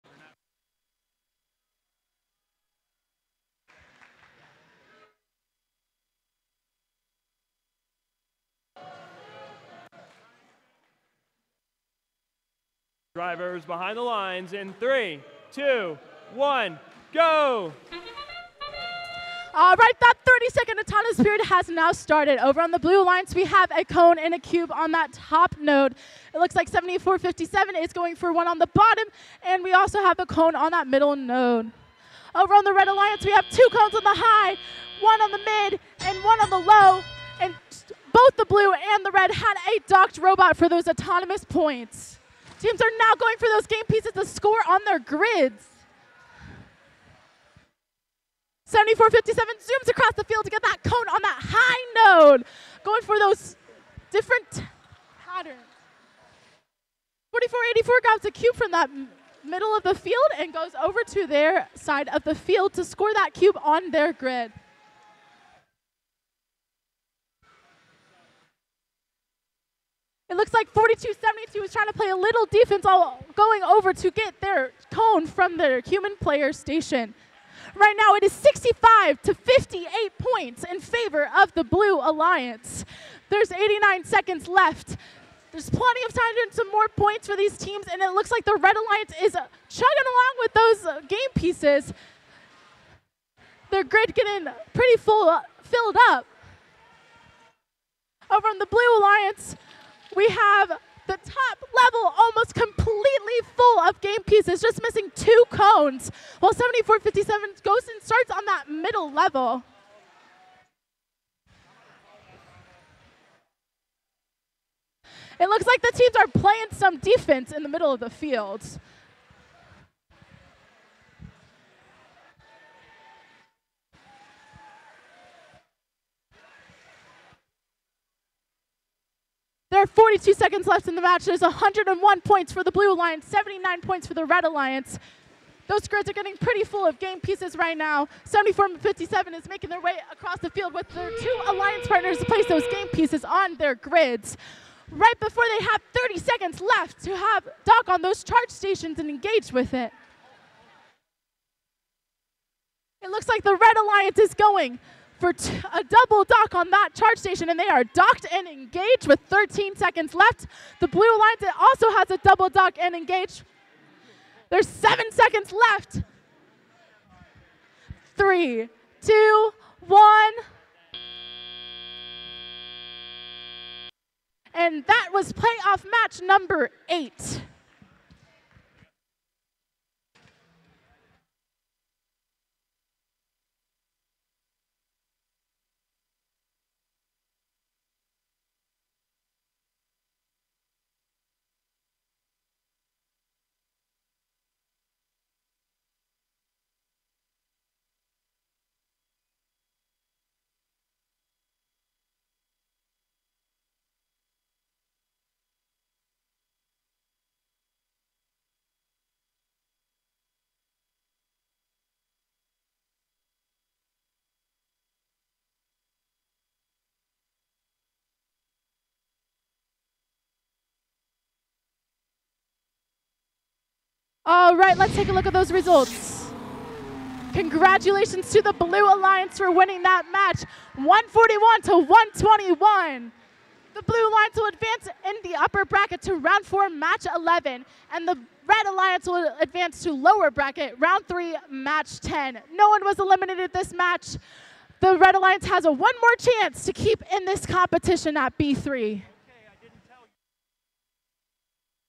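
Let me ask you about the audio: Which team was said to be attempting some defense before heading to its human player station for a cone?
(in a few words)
4272.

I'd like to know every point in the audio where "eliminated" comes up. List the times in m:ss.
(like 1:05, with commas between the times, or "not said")
4:02.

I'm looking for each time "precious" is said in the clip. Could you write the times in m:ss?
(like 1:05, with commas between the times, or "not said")
not said.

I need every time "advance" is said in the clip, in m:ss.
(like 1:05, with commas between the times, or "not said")
3:54, 3:59.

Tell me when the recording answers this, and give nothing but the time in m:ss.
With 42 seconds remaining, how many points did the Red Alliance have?
2:13.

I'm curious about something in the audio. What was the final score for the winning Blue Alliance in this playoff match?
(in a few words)
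141.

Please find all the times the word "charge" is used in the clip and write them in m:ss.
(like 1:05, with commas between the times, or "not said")
2:28, 2:36.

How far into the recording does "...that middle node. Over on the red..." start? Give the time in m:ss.
0:30.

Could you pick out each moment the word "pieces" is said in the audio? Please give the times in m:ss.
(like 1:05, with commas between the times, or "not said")
0:43, 1:31, 1:44, 2:17, 2:22.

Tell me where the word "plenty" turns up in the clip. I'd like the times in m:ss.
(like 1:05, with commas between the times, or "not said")
1:25.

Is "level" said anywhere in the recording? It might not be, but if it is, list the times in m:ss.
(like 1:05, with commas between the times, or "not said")
1:41, 1:49.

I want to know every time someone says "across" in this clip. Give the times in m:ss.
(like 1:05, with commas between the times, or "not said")
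0:49, 2:20.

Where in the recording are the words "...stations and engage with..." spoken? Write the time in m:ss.
2:28.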